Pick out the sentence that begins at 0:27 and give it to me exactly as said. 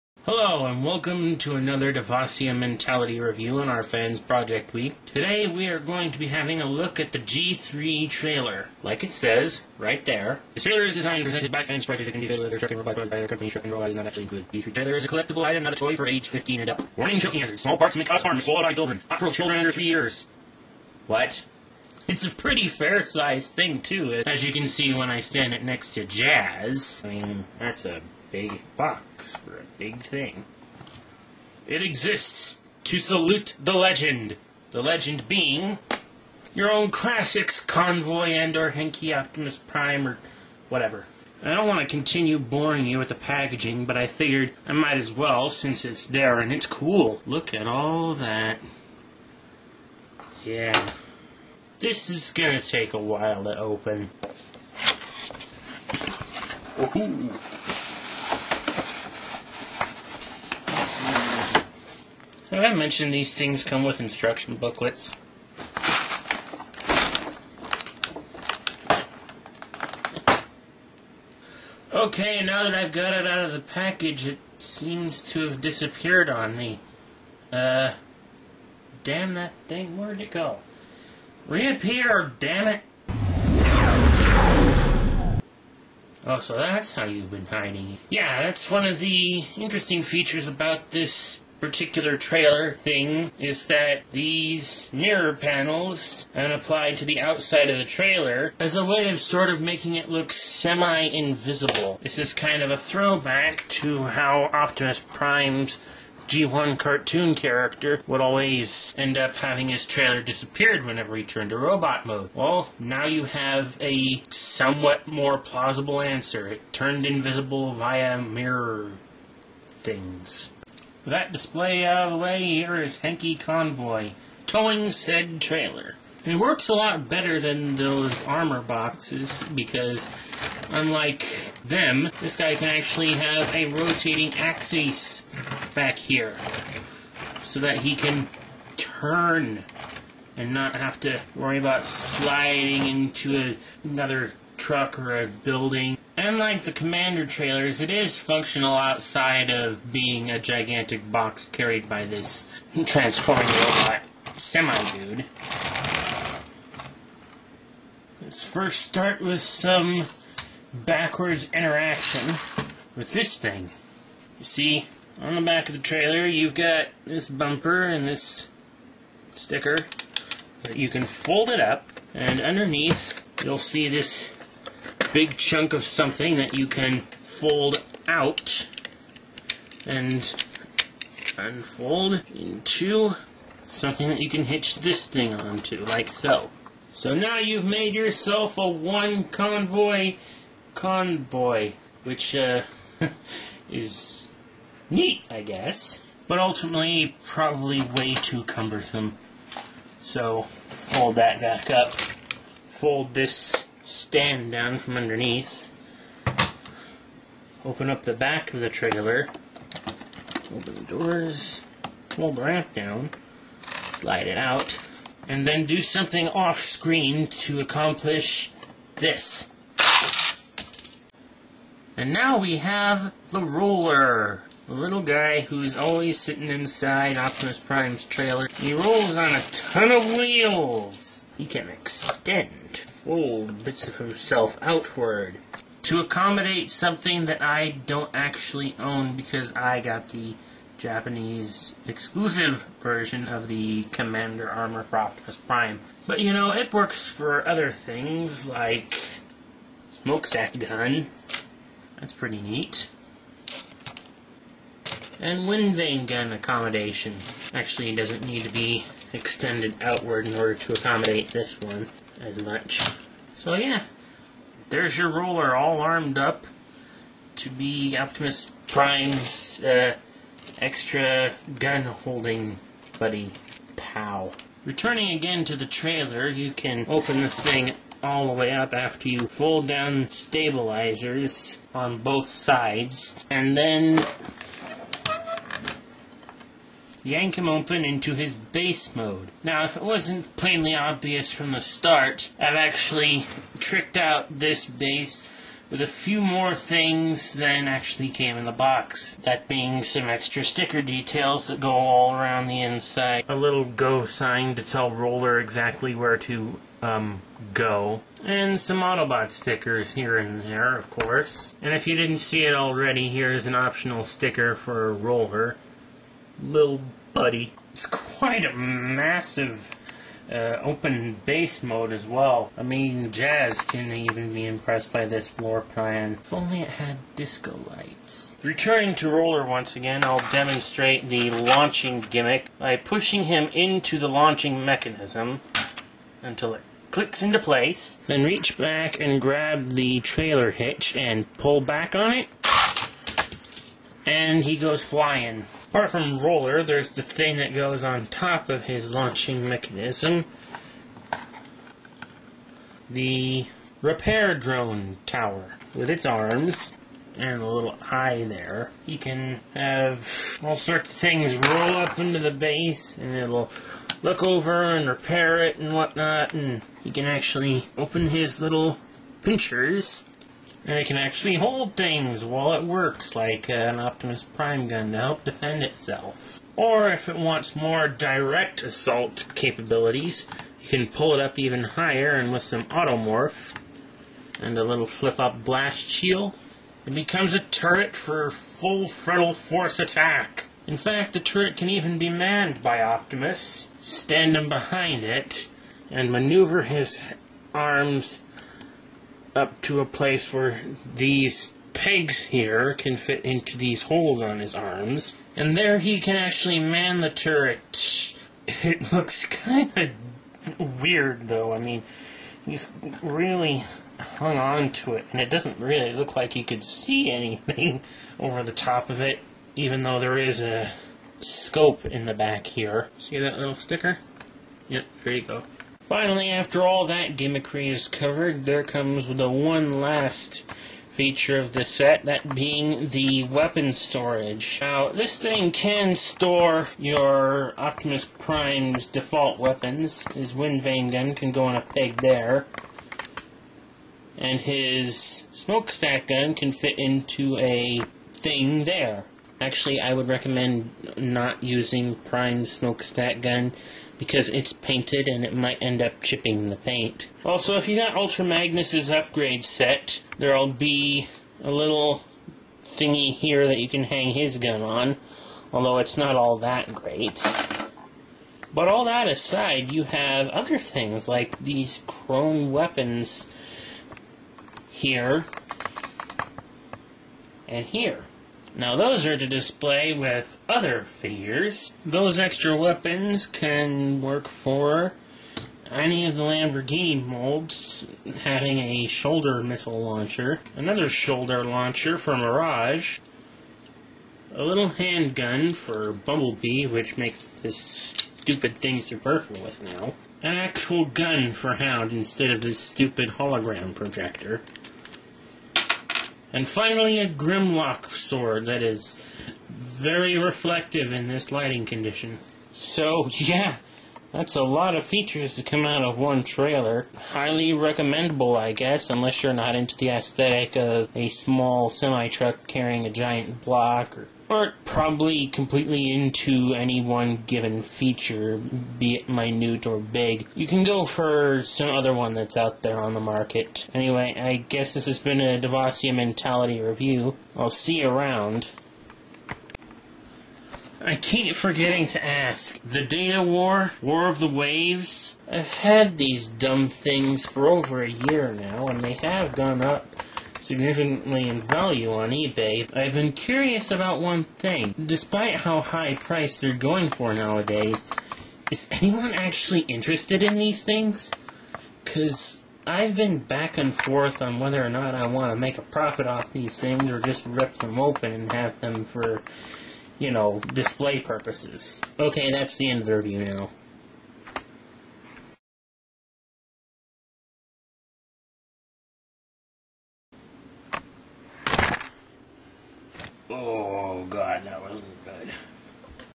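I mean, that's a big box for a big thing.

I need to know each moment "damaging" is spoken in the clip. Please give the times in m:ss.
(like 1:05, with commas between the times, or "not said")
not said.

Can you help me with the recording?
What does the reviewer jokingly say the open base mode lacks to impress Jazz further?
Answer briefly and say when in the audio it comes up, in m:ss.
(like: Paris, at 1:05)
Disco lights, at 5:27.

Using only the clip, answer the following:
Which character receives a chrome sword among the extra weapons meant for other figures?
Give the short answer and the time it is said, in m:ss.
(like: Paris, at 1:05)
Grimlock, at 8:27.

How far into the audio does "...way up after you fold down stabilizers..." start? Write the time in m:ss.
4:38.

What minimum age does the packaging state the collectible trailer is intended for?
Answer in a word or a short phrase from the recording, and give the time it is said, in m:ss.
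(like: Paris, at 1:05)
15 and up, at 0:16.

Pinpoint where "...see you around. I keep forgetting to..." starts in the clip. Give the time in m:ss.
8:57.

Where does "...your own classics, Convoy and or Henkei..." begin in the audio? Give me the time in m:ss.
0:36.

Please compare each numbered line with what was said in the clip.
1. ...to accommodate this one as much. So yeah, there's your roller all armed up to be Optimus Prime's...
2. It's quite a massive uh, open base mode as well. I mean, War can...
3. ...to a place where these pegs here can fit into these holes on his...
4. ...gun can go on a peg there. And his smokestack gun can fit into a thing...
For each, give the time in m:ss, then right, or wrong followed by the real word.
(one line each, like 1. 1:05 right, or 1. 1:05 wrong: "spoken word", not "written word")
1. 4:20 right
2. 5:17 wrong: "Jazz", not "War"
3. 6:39 right
4. 7:20 right.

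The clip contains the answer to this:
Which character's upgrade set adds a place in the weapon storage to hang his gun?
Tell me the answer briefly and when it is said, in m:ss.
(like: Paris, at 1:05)
Ultra Magnus, at 7:37.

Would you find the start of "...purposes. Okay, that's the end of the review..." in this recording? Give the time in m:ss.
9:30.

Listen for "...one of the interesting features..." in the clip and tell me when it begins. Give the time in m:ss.
1:28.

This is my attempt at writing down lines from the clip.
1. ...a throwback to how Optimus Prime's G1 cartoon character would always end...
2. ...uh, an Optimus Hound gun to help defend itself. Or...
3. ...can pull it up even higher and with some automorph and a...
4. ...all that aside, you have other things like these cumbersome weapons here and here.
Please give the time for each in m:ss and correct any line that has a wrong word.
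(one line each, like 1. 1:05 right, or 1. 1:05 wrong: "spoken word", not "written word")
1. 1:42 right
2. 6:13 wrong: "Prime", not "Hound"
3. 6:20 right
4. 7:48 wrong: "chrome", not "cumbersome".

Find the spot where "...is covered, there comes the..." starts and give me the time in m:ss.
7:07.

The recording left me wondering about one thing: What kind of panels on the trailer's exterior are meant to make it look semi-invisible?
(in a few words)
Mirror panels.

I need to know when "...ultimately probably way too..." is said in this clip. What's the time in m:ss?
3:16.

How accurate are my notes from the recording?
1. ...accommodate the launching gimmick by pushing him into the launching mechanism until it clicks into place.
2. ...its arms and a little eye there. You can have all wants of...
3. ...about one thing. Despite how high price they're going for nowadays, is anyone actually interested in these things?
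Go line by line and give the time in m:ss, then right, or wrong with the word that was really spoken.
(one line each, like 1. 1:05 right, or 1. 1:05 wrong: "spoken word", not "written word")
1. 5:30 wrong: "demonstrate", not "accommodate"
2. 5:55 wrong: "sorts", not "wants"
3. 9:13 right.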